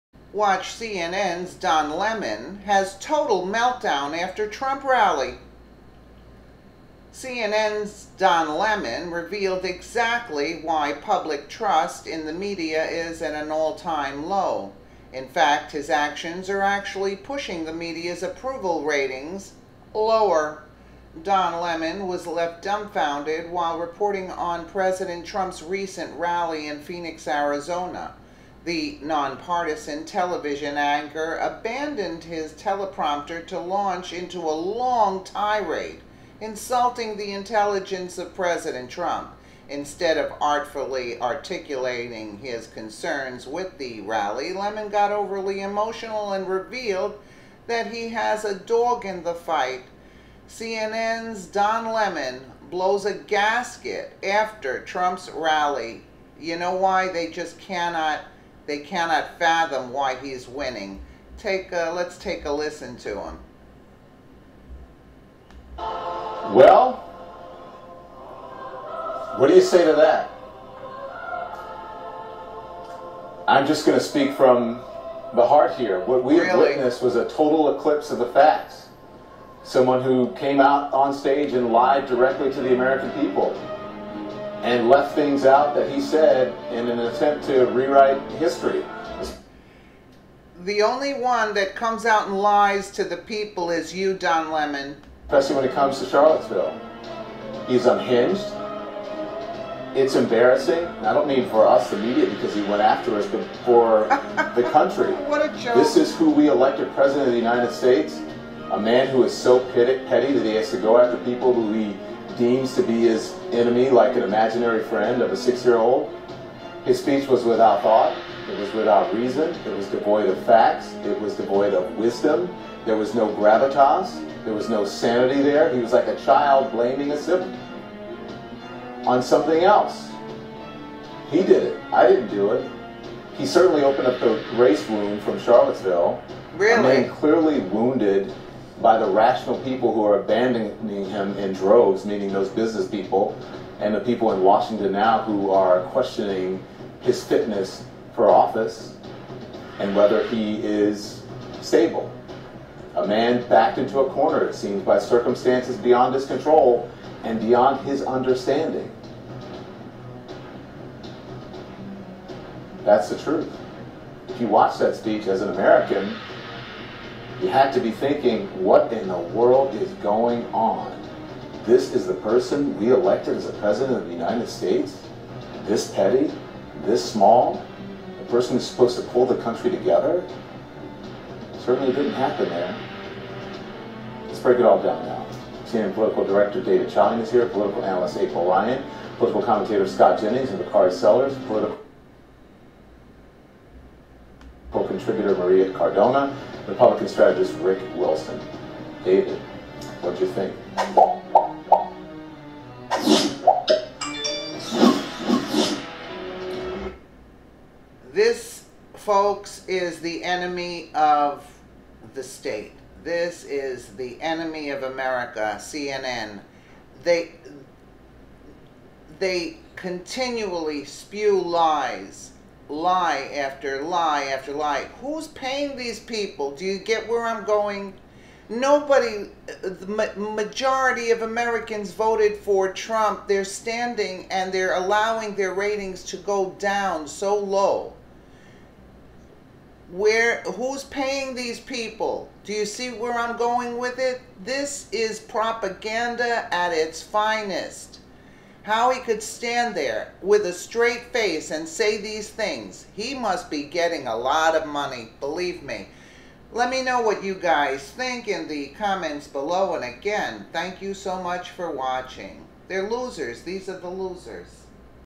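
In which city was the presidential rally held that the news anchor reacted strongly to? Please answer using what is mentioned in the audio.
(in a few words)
Phoenix, Arizona.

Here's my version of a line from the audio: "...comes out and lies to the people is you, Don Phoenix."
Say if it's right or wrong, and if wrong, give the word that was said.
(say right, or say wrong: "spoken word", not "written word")
wrong: "Lemon", not "Phoenix".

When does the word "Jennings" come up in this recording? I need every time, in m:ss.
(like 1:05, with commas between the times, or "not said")
3:10.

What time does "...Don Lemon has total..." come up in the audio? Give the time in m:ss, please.
0:01.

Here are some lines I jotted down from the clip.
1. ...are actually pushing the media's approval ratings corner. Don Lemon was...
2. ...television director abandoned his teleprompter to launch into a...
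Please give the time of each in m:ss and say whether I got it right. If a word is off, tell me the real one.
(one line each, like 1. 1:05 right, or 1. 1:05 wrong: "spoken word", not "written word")
1. 0:16 wrong: "lower", not "corner"
2. 0:30 wrong: "anchor", not "director".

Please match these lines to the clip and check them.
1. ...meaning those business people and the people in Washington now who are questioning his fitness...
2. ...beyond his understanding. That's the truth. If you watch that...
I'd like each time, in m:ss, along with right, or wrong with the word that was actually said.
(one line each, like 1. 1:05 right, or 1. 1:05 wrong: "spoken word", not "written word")
1. 2:22 right
2. 2:37 right.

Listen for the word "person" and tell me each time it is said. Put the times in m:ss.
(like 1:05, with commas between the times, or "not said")
2:52, 2:58.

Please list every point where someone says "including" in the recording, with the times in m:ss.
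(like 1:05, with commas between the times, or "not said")
not said.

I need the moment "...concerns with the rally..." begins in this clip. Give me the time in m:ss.
0:42.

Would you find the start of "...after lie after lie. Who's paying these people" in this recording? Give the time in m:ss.
3:43.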